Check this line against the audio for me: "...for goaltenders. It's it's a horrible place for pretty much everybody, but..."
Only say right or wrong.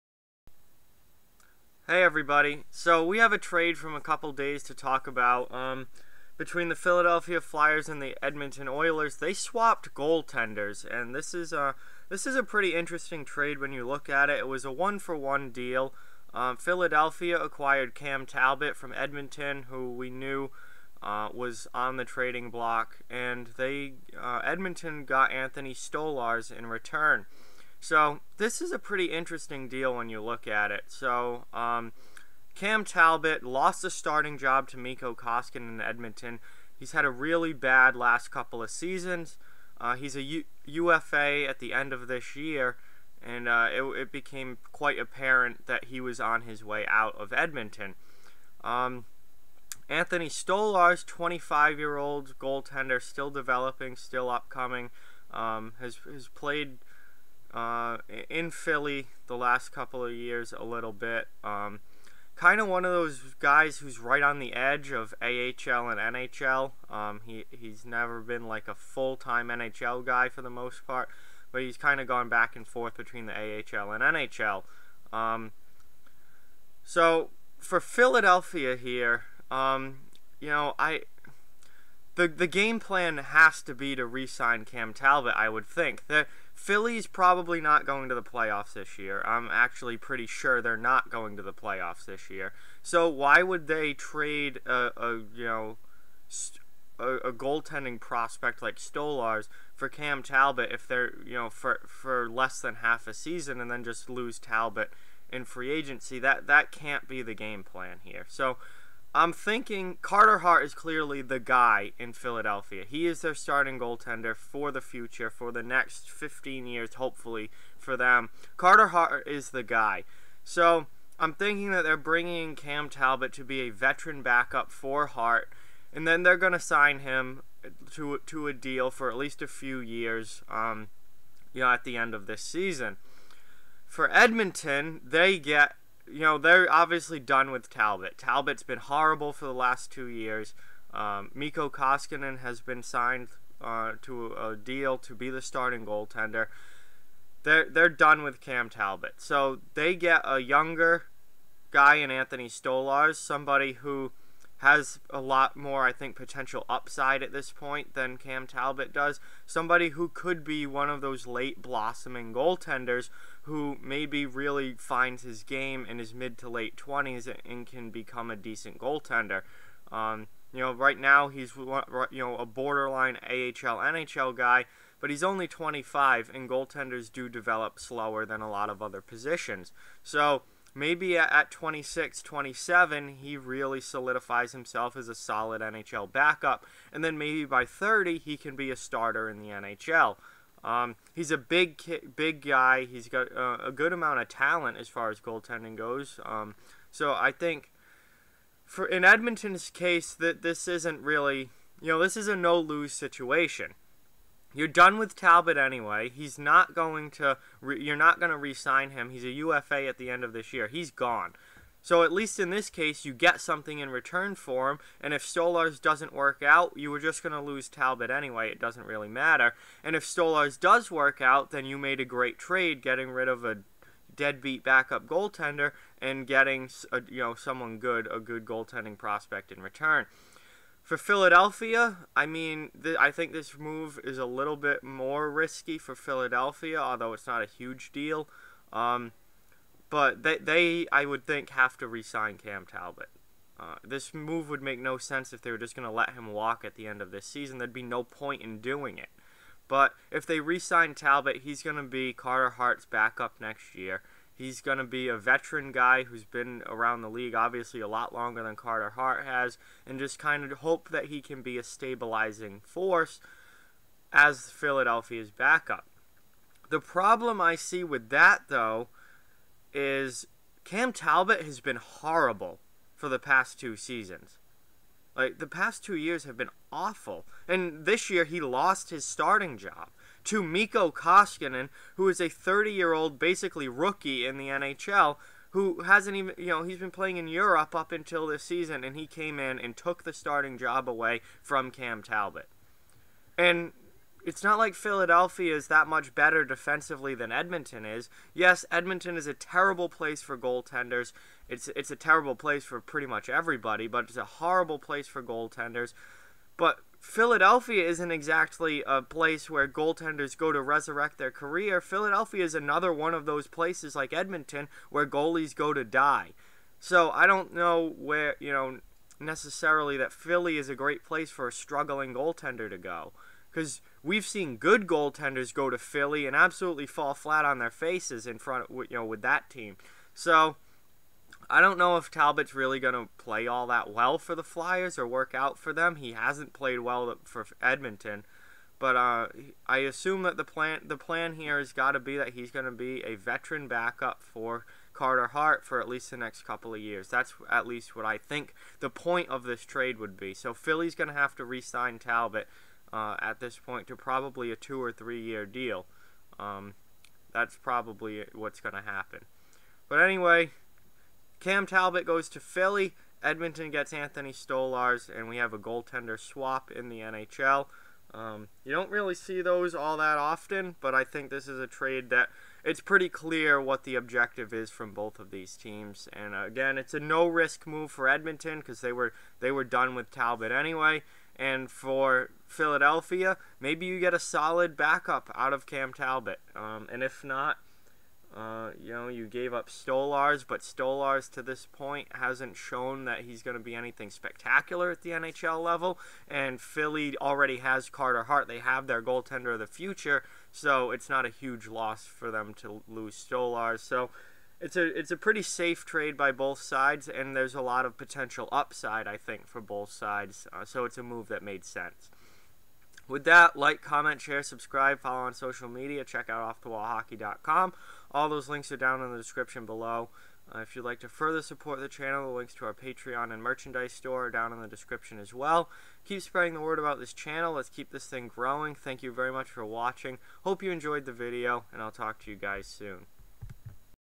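wrong.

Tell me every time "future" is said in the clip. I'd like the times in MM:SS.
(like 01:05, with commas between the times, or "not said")
01:54, 06:39.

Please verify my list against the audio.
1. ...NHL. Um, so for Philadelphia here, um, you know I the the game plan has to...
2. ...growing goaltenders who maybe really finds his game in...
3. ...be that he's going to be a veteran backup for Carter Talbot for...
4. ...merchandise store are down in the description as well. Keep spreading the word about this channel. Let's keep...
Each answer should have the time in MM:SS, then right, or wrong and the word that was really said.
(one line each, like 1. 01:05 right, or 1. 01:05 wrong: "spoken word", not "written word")
1. 01:14 right
2. 02:41 wrong: "blossoming", not "growing"
3. 05:41 wrong: "Hart", not "Talbot"
4. 07:03 right.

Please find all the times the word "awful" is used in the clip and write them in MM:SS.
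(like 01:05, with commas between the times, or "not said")
04:36.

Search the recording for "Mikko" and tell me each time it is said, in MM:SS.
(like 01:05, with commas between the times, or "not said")
00:34, 02:21, 04:40.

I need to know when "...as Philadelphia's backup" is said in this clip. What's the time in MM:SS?
04:24.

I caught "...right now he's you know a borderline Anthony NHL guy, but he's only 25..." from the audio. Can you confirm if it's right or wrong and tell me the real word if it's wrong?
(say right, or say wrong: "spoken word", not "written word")
wrong: "AHL", not "Anthony".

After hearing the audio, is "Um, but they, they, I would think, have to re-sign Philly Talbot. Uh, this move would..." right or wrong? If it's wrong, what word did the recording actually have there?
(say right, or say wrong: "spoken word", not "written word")
wrong: "Cam", not "Philly".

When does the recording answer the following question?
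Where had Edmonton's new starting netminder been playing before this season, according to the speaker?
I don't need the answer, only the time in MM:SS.
04:47.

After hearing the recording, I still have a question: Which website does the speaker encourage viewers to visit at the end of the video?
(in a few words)
offthewallhockey.com.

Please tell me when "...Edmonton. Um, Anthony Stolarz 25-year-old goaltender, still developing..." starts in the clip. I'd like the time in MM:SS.
00:47.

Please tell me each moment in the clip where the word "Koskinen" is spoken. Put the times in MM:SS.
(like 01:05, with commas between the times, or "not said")
00:35, 02:21, 04:40.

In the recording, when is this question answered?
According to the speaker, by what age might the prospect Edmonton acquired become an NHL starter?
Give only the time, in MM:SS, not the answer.
03:07.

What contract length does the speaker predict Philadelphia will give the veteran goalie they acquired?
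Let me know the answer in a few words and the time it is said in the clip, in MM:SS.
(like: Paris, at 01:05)
2 or 3 years, at 05:54.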